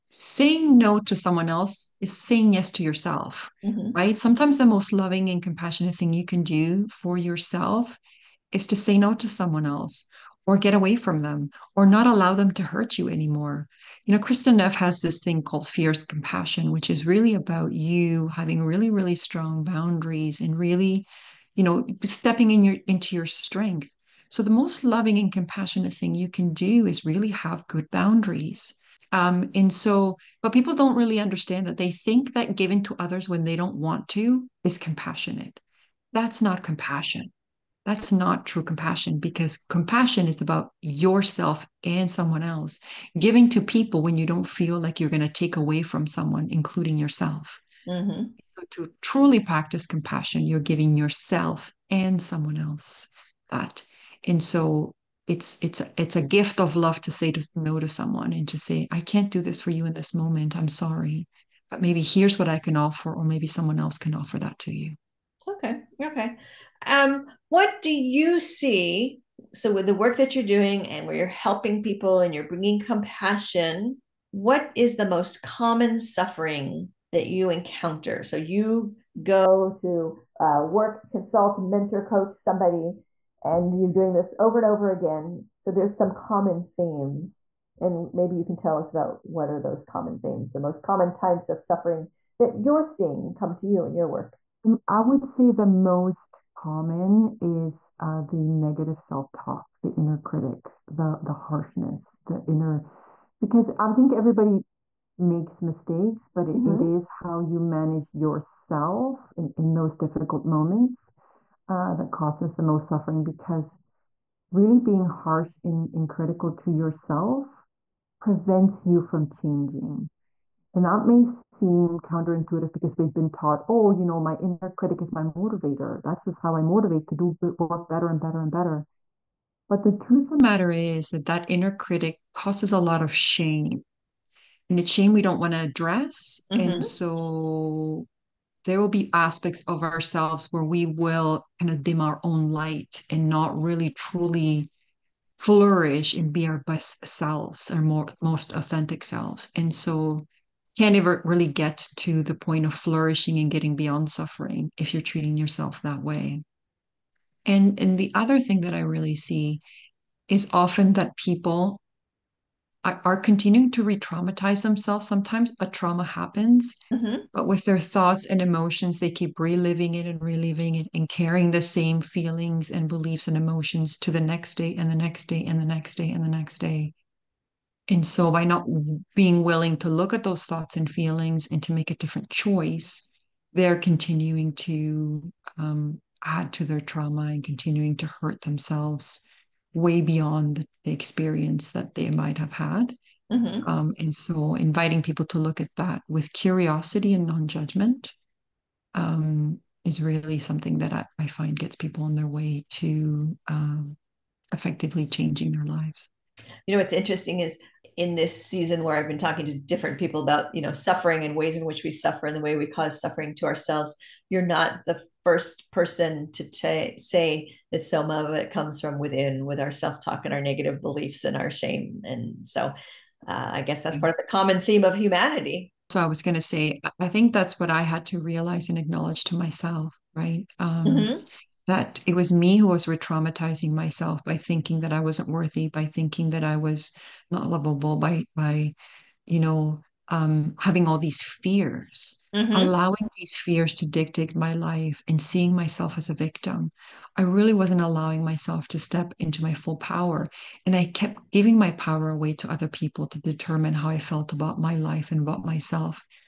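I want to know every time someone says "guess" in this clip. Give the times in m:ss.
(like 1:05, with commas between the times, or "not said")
3:43.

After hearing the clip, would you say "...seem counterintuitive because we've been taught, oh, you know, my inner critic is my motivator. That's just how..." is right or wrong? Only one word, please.
right.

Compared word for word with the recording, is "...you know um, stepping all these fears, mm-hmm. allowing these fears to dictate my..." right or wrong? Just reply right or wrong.
wrong.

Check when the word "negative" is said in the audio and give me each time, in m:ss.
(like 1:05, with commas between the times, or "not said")
1:38, 3:40.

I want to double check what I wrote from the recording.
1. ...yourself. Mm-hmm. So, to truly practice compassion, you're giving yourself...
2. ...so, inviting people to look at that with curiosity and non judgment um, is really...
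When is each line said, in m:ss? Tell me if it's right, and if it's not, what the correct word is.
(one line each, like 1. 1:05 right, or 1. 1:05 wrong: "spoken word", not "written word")
1. 0:46 right
2. 3:14 right.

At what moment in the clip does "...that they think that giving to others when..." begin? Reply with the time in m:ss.
0:31.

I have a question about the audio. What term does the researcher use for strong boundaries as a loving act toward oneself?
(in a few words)
fierce compassion.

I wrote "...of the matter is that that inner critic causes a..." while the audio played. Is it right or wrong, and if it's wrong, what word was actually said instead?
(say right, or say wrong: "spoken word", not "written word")
right.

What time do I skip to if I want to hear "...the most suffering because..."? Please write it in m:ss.
1:52.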